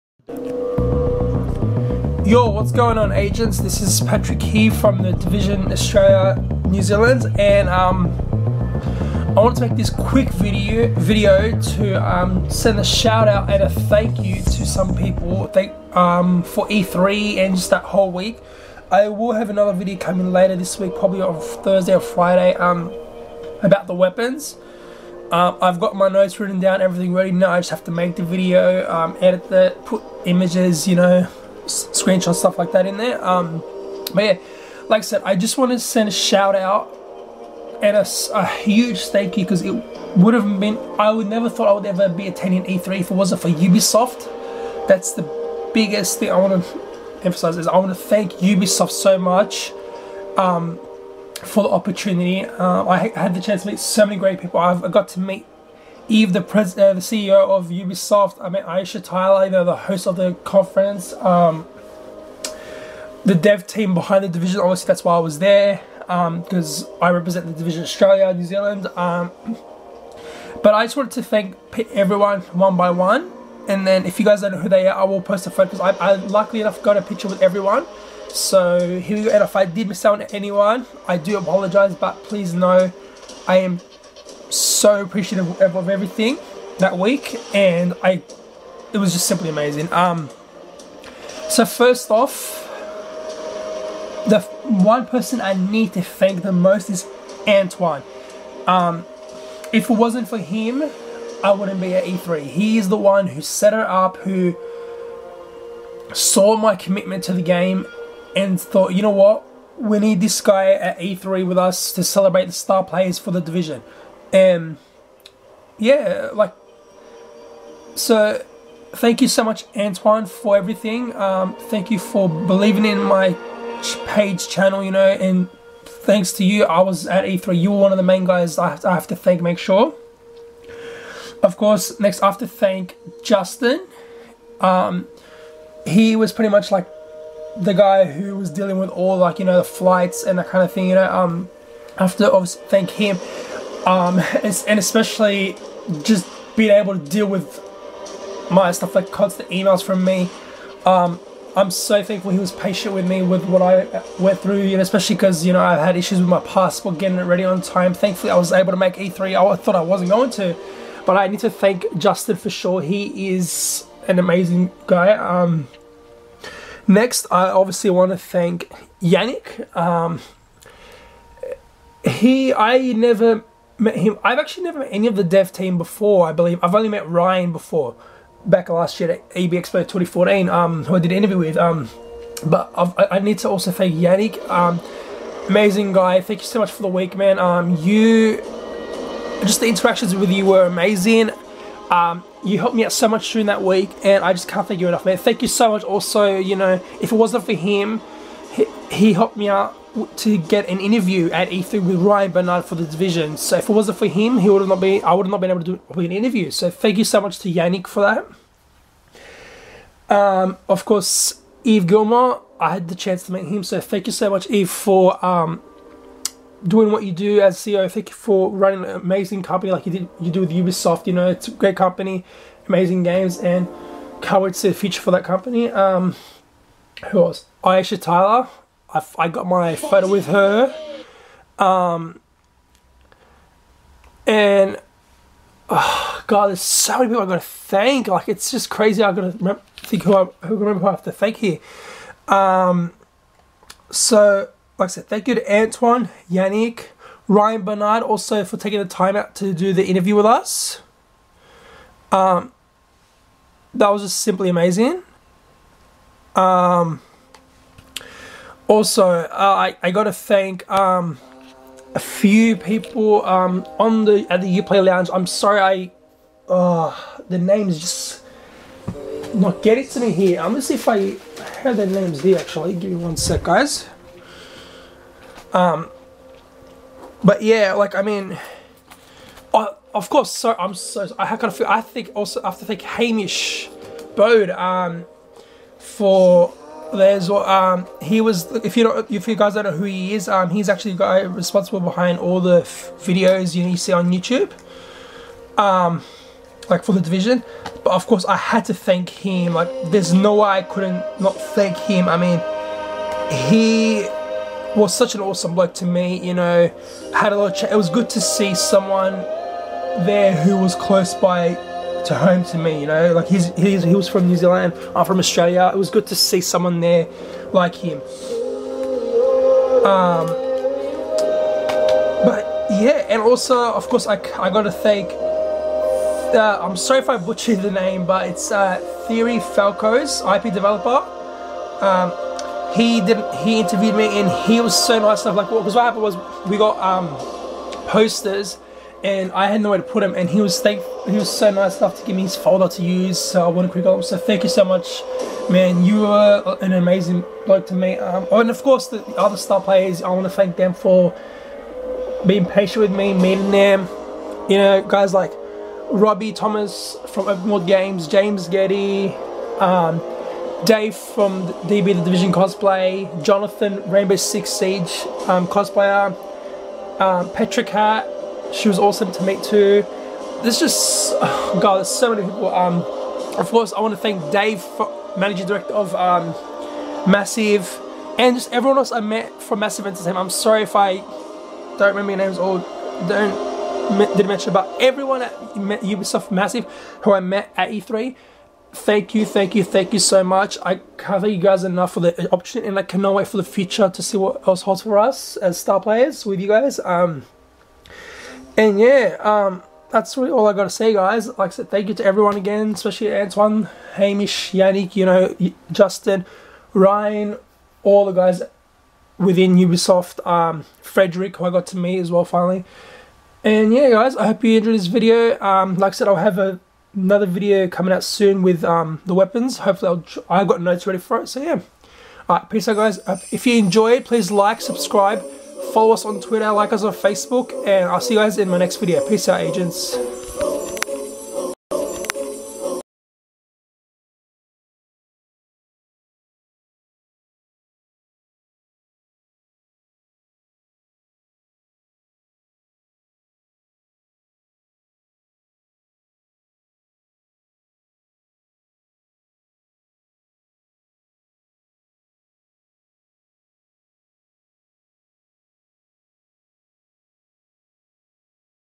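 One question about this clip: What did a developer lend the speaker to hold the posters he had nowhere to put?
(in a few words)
His folder.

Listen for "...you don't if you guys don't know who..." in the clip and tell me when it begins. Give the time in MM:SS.
04:48.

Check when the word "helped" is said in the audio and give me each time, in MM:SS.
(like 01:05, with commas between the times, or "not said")
03:12, 03:19.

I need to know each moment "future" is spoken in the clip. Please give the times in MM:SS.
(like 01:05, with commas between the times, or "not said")
03:44, 06:33.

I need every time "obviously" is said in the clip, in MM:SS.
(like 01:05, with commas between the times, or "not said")
01:04, 02:22, 02:47.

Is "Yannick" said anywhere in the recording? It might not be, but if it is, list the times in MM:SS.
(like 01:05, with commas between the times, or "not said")
02:49, 03:03, 03:27, 04:06, 06:44.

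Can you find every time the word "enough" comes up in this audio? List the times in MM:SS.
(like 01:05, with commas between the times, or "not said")
01:16, 03:14, 05:35, 05:41, 06:31.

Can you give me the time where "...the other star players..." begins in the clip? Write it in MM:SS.
05:48.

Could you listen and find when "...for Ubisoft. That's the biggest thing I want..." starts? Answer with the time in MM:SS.
00:43.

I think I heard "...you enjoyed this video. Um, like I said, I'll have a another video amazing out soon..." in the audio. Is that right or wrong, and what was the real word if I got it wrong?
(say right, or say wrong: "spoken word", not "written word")
wrong: "coming", not "amazing".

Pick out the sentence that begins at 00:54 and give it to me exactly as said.
I've, got to meet Yves, the, pres- uh, the CEO of Ubisoft.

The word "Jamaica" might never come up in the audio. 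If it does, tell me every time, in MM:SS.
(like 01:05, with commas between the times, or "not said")
not said.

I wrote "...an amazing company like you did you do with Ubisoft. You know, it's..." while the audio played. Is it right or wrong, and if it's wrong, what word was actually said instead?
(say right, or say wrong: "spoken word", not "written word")
right.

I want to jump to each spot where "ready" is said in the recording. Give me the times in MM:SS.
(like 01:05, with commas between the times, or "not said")
00:27, 02:37, 07:00.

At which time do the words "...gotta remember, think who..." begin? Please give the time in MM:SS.
03:59.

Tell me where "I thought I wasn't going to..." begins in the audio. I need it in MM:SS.
02:39.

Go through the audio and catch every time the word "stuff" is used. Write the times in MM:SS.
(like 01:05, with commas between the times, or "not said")
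00:32, 02:28.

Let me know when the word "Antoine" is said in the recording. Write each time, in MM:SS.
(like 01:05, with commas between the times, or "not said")
01:37, 01:59, 04:05, 06:43.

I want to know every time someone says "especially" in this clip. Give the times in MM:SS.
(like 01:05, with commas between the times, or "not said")
02:24, 02:34, 06:42.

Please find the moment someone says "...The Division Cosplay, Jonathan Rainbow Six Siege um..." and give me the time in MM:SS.
06:01.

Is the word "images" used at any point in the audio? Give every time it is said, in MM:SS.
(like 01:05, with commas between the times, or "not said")
00:30.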